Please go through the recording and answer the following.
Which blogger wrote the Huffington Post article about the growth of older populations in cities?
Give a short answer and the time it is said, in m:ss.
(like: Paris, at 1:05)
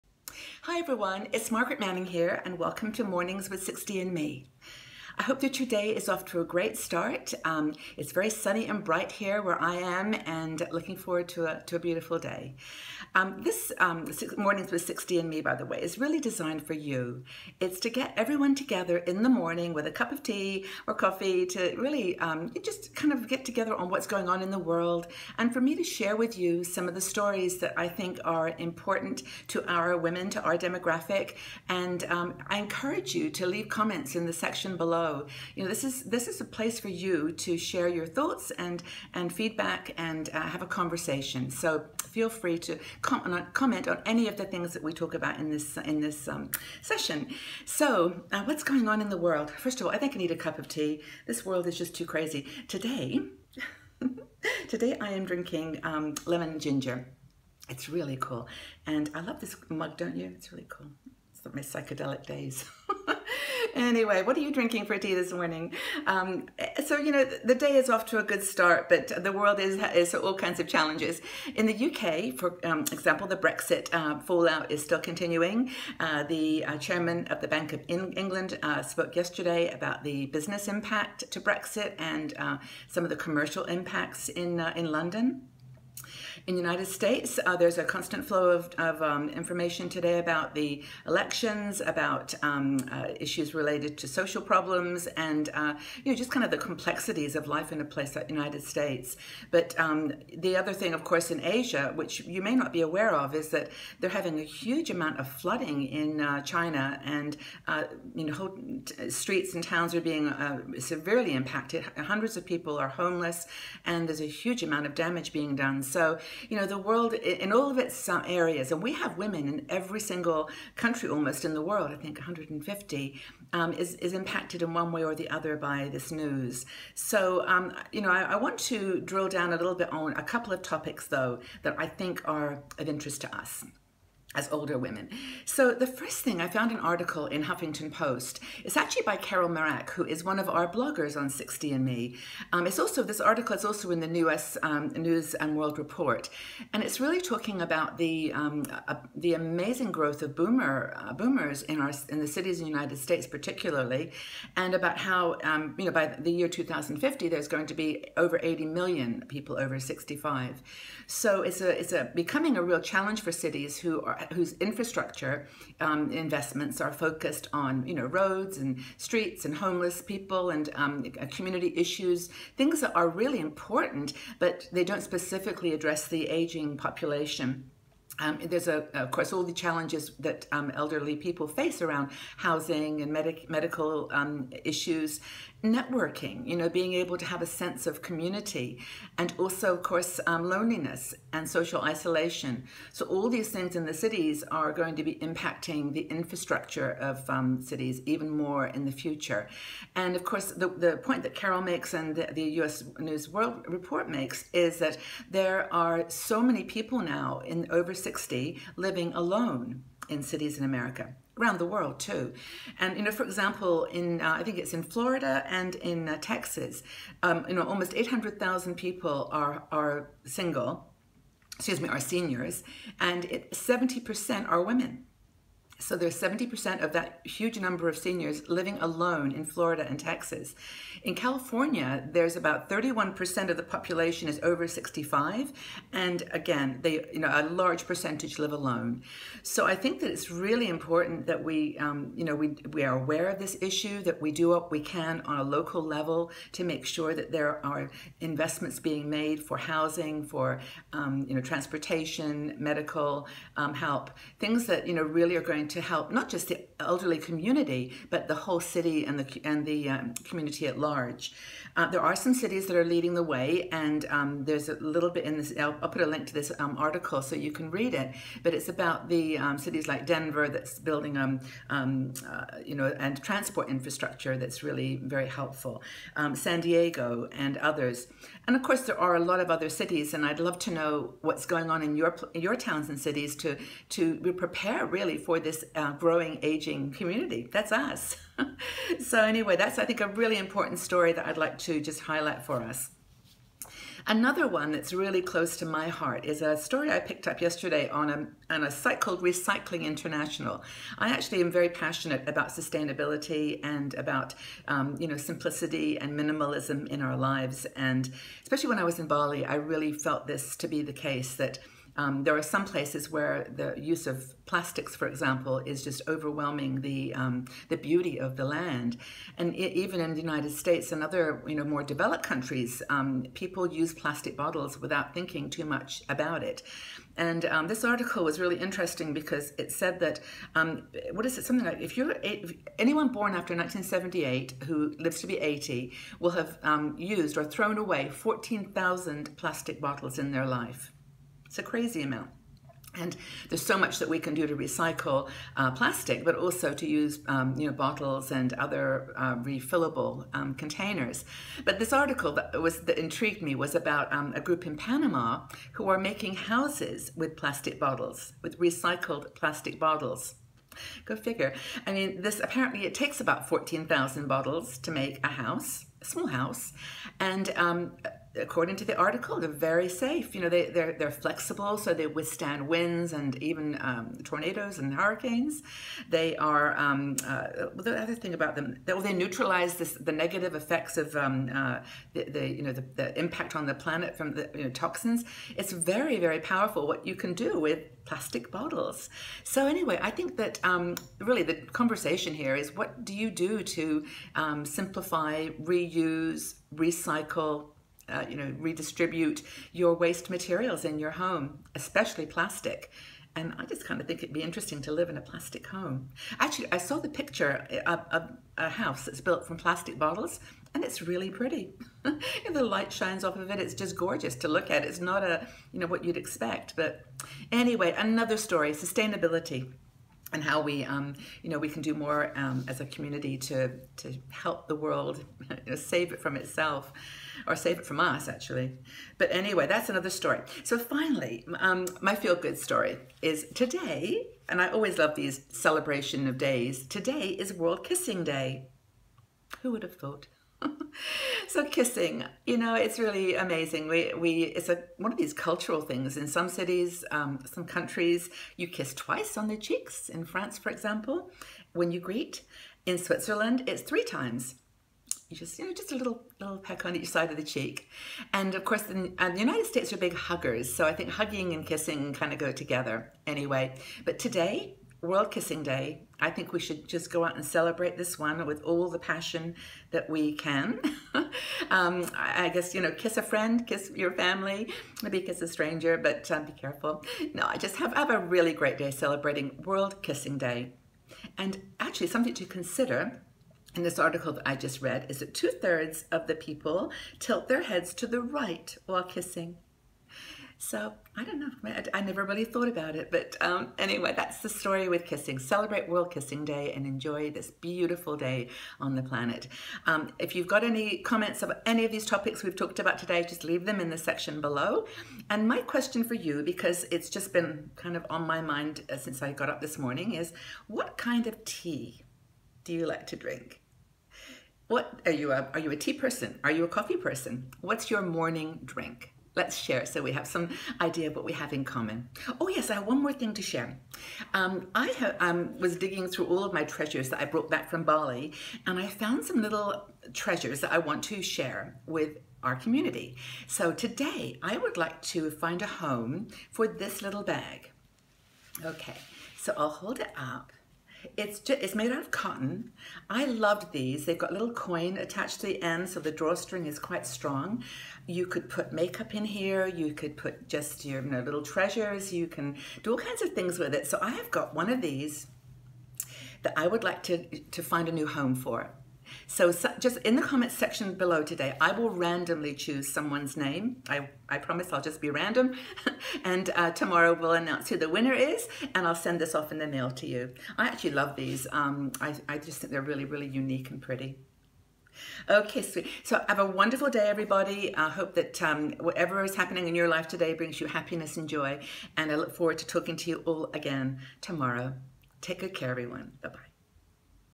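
Carol Marak, at 2:19.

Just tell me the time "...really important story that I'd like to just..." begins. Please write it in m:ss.
4:50.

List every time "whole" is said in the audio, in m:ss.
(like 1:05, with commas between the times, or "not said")
1:48, 4:18.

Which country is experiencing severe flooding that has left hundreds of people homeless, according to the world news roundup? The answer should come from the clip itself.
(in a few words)
China.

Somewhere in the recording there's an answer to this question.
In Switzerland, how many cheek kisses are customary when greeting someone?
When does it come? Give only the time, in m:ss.
7:33.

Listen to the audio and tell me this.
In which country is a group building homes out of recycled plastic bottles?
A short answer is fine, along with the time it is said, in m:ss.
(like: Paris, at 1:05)
Panama, at 5:54.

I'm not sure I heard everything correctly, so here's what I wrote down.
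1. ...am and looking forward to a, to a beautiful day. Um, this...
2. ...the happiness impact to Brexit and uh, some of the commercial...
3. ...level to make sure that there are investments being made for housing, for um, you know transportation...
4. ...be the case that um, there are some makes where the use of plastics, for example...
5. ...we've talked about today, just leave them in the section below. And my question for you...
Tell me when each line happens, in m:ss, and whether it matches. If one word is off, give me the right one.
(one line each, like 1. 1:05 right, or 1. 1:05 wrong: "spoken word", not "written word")
1. 0:09 right
2. 1:20 wrong: "business", not "happiness"
3. 4:05 right
4. 5:10 wrong: "places", not "makes"
5. 8:22 right.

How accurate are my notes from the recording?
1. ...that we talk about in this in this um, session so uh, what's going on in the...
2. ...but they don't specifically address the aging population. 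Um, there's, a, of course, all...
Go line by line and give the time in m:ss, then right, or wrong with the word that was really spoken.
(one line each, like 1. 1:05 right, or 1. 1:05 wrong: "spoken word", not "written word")
1. 0:44 right
2. 2:54 right.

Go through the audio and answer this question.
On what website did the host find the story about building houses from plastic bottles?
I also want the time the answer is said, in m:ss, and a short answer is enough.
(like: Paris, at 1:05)
Recycling International, at 4:59.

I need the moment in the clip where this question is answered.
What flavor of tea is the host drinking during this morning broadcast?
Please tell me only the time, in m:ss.
0:56.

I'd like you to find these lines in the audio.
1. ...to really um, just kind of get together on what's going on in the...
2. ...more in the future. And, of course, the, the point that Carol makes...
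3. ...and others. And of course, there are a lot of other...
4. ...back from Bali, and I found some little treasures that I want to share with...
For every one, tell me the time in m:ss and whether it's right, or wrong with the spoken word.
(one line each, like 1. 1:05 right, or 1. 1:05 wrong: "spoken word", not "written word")
1. 0:21 right
2. 3:18 right
3. 4:37 right
4. 8:47 right.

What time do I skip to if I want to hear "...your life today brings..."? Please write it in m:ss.
9:39.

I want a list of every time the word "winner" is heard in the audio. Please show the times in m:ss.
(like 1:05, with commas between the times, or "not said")
9:27.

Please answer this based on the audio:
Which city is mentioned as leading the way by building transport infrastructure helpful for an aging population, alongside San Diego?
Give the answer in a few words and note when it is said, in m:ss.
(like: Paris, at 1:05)
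Denver, at 4:30.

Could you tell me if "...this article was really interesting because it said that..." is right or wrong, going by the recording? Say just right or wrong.
right.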